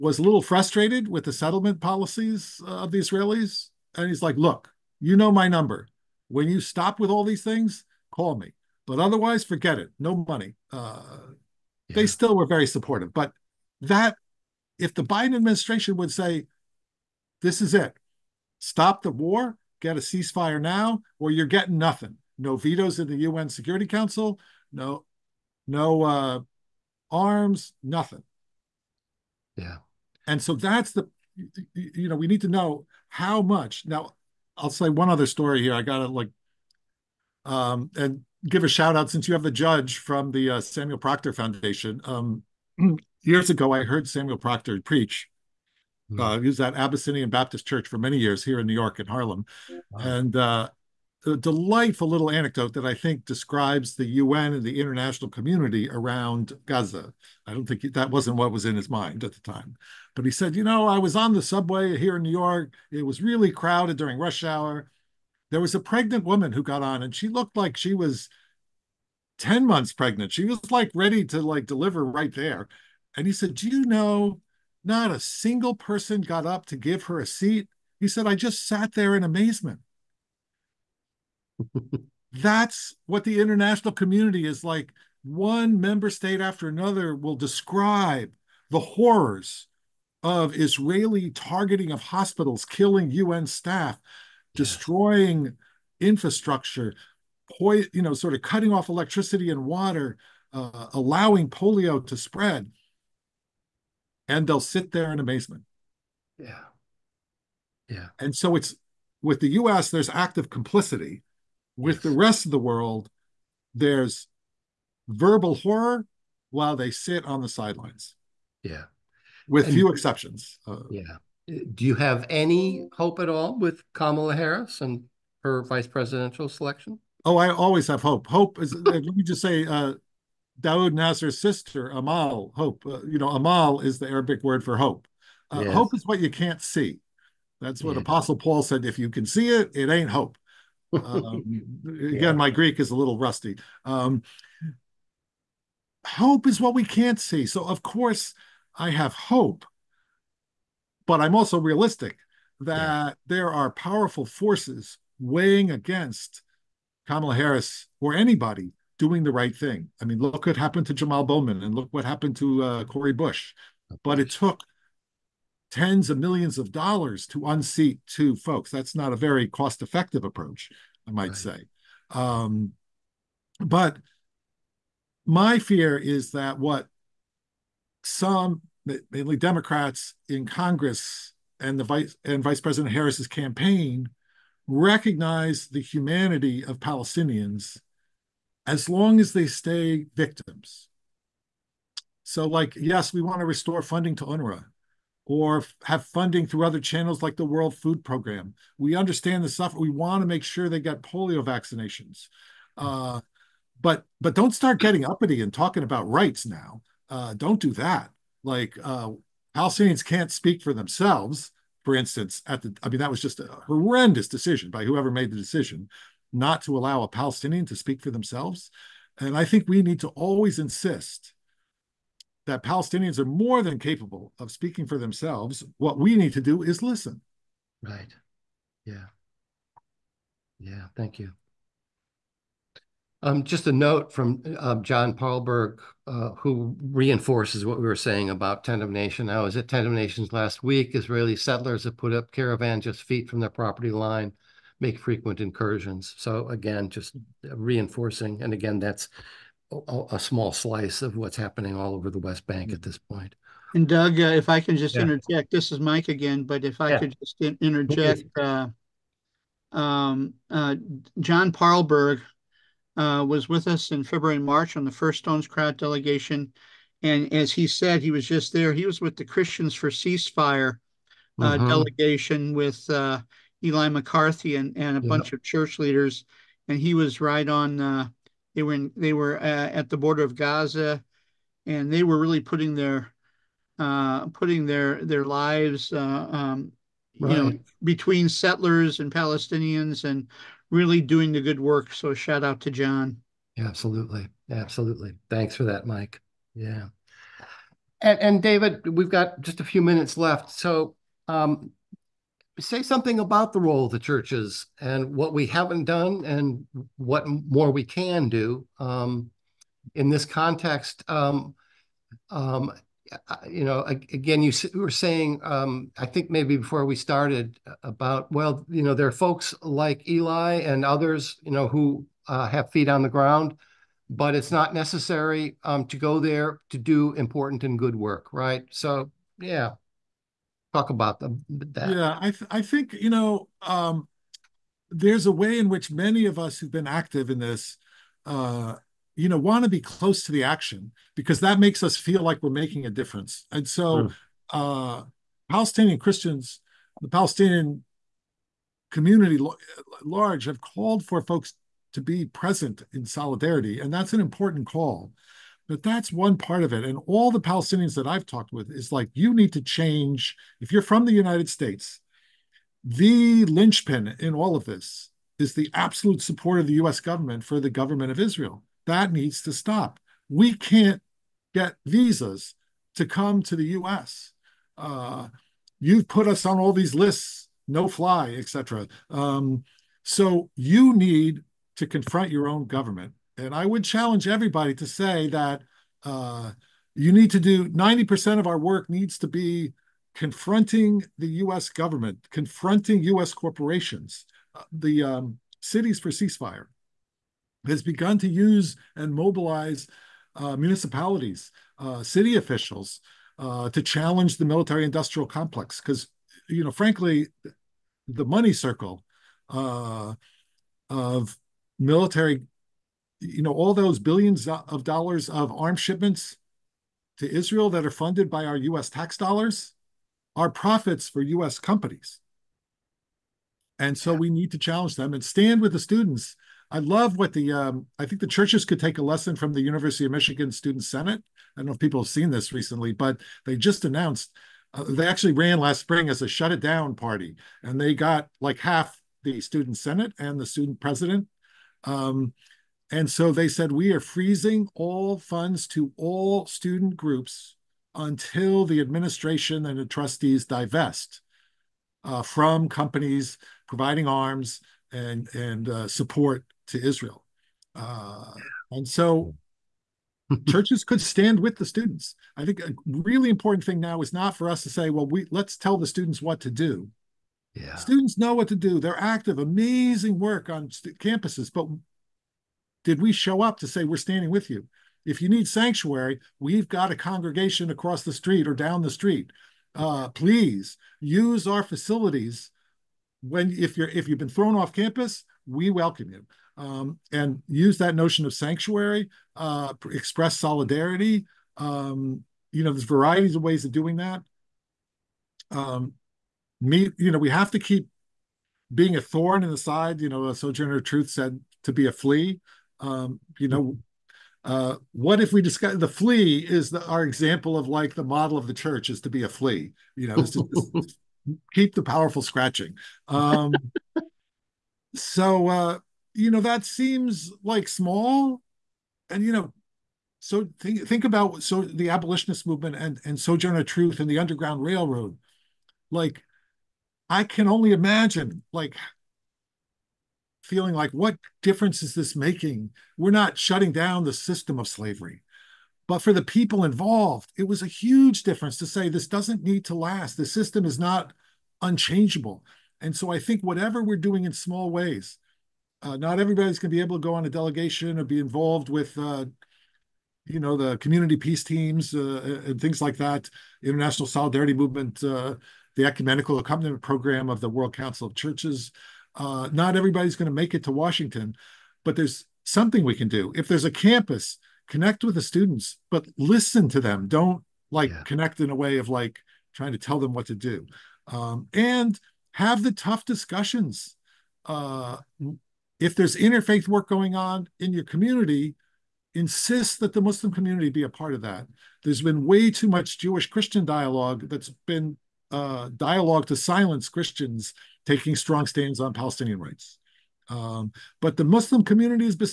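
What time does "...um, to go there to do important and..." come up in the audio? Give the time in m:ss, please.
5:25.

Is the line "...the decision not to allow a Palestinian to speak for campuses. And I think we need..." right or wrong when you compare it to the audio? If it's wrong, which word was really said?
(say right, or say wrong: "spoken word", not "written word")
wrong: "themselves", not "campuses".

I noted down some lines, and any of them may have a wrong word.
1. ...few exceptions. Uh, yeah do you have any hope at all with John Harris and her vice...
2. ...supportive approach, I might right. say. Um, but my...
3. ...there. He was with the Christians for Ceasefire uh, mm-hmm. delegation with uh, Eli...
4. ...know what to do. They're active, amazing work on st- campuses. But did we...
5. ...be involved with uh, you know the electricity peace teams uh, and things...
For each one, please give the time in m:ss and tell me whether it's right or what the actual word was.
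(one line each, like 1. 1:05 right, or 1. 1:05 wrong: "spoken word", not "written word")
1. 1:59 wrong: "Kamala", not "John"
2. 2:49 wrong: "effective", not "supportive"
3. 4:28 right
4. 7:48 right
5. 9:08 wrong: "community", not "electricity".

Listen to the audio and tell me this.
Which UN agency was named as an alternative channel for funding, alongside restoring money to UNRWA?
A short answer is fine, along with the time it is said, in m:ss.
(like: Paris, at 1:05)
World Food Program, at 3:17.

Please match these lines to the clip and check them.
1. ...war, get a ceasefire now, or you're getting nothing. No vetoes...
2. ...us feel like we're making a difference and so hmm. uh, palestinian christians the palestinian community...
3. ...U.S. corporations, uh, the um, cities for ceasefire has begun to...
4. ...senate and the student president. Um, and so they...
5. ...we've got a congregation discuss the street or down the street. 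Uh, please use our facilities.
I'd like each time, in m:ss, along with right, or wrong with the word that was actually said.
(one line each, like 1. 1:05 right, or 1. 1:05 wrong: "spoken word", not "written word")
1. 0:19 right
2. 5:41 right
3. 6:33 right
4. 7:19 right
5. 7:56 wrong: "across", not "discuss".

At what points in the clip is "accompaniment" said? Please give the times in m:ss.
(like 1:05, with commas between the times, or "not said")
9:16.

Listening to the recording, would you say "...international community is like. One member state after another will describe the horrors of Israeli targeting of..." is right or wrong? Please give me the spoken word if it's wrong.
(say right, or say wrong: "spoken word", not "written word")
right.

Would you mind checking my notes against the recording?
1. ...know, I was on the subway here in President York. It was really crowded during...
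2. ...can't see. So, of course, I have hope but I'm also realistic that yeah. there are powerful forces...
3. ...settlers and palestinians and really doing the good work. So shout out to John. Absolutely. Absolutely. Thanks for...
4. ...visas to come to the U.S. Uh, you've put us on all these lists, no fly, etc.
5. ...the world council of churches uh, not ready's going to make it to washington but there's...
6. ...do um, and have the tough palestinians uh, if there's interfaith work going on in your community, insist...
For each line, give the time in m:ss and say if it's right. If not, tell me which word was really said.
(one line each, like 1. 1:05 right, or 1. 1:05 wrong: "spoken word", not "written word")
1. 1:00 wrong: "New", not "President"
2. 2:26 right
3. 4:48 right
4. 6:11 right
5. 9:17 wrong: "everybody", not "ready"
6. 9:30 wrong: "discussions", not "palestinians".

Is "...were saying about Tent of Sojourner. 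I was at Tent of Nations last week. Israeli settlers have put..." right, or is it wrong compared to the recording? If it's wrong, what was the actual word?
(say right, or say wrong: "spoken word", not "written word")
wrong: "Nation", not "Sojourner".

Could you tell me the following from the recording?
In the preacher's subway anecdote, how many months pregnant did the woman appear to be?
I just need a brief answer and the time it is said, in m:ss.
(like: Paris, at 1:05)
10, at 1:09.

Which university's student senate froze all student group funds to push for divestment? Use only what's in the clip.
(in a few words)
University of Michigan.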